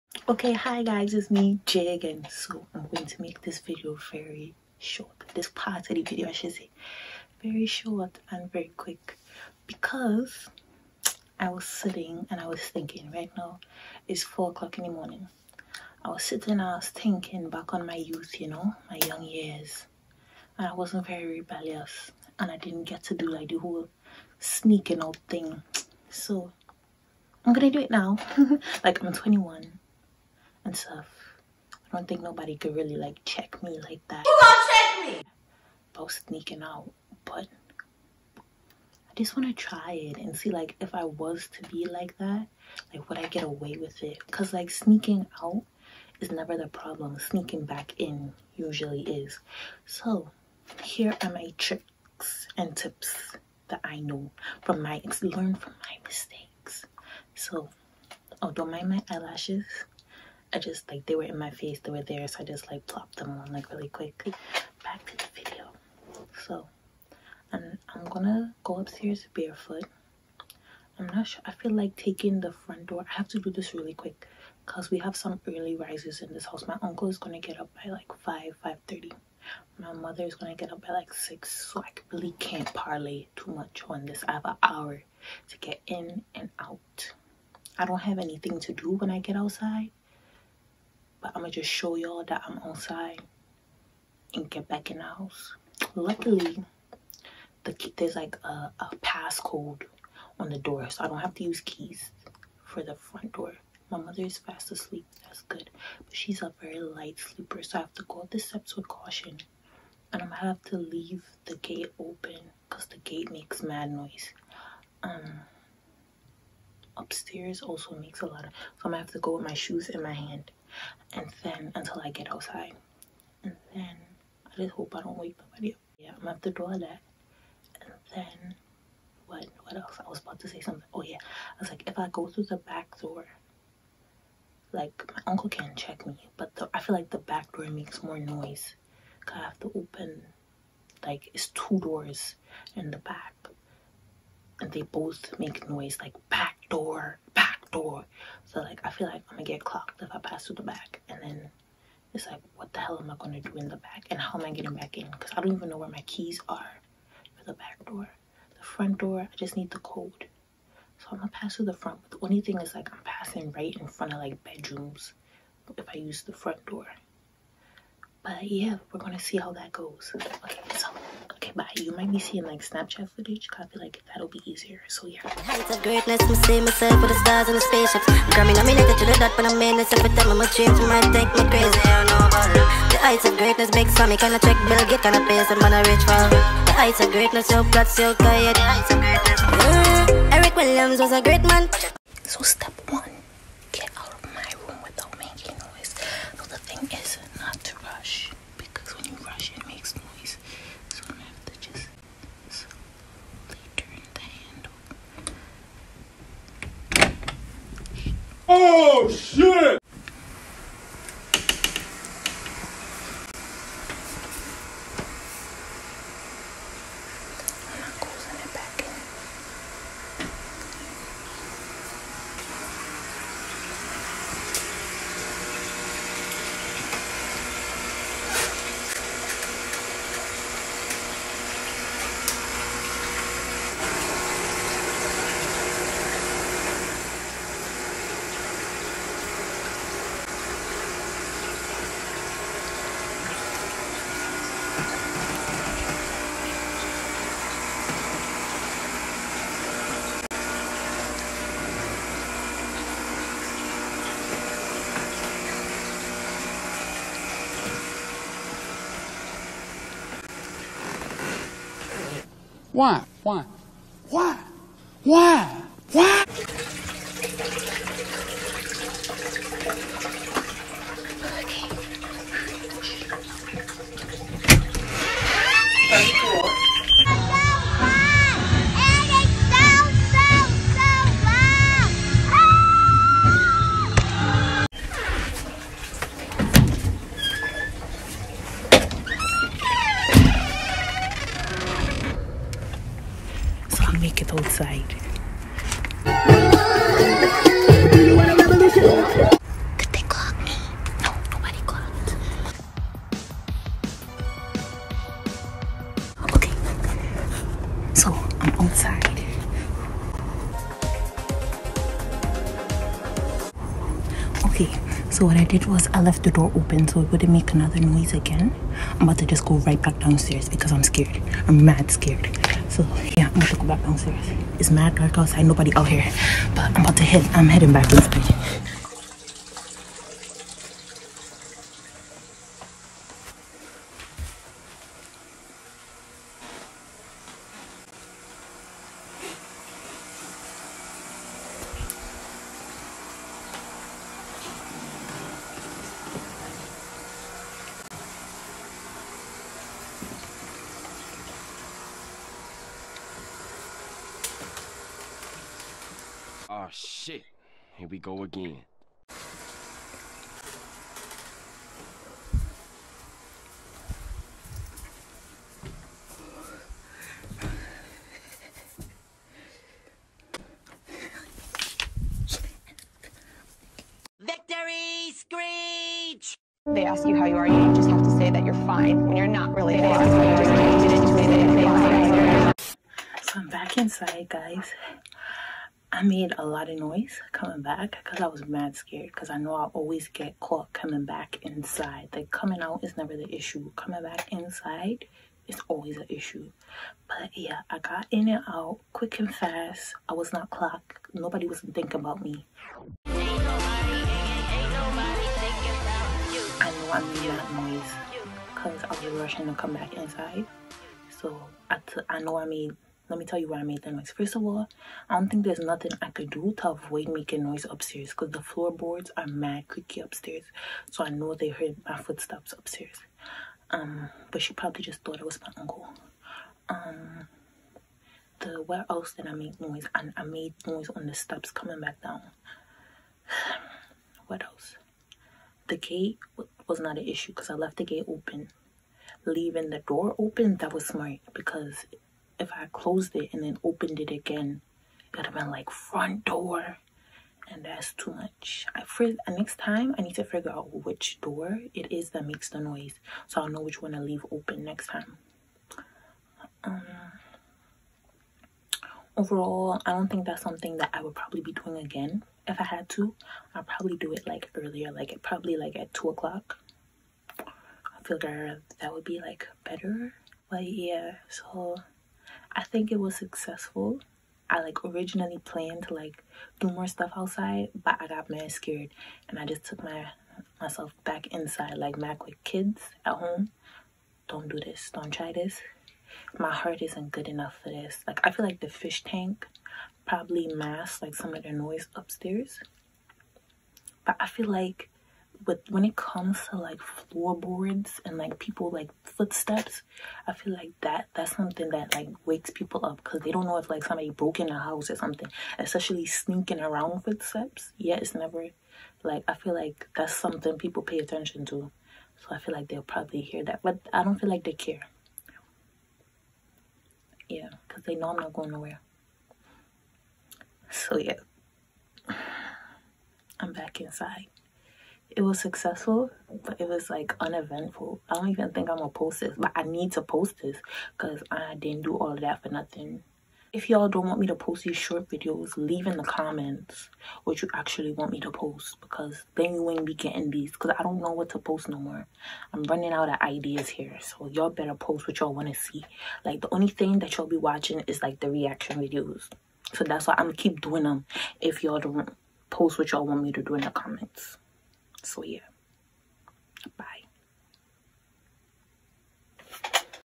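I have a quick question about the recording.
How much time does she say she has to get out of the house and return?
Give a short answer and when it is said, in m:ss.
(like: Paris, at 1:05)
An hour, at 1:24.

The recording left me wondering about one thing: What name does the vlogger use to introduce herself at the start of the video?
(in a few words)
Jay.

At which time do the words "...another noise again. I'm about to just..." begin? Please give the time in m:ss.
5:17.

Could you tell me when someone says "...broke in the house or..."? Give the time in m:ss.
8:24.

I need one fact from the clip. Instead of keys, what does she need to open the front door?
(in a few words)
A passcode.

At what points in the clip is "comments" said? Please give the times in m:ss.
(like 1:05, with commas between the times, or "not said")
8:56, 9:13.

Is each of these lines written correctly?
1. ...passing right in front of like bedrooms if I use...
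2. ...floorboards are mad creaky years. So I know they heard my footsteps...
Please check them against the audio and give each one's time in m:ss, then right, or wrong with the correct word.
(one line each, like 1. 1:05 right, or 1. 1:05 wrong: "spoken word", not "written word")
1. 2:43 right
2. 6:58 wrong: "upstairs", not "years".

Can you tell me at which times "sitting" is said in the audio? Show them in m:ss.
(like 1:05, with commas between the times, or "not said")
0:11, 0:16.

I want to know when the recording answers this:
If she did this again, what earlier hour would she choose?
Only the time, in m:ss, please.
7:45.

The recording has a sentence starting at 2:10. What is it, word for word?
I was about to say something.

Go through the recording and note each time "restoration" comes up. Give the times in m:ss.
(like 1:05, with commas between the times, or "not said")
not said.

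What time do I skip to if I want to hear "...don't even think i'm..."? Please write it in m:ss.
8:48.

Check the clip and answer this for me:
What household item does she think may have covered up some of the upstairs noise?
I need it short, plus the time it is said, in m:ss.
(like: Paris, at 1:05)
The fish tank, at 8:08.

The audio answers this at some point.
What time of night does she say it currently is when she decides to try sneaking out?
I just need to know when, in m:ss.
0:14.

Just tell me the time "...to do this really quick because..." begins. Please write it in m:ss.
1:13.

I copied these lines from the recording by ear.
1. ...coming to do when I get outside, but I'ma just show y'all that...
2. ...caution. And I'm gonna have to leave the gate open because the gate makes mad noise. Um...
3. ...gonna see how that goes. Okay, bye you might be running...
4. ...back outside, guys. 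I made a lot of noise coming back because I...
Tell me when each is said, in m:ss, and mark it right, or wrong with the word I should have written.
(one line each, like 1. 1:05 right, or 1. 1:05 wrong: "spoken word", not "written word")
1. 1:28 wrong: "anything", not "coming"
2. 1:48 right
3. 2:48 wrong: "seeing", not "running"
4. 6:23 wrong: "inside", not "outside".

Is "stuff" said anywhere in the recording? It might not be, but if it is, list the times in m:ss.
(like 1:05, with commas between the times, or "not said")
0:30, 7:56.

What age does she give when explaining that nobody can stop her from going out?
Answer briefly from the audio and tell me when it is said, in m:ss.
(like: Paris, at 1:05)
21, at 0:29.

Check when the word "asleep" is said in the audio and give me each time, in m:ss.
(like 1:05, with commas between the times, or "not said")
1:44.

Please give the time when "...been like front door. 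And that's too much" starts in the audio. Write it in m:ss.
7:25.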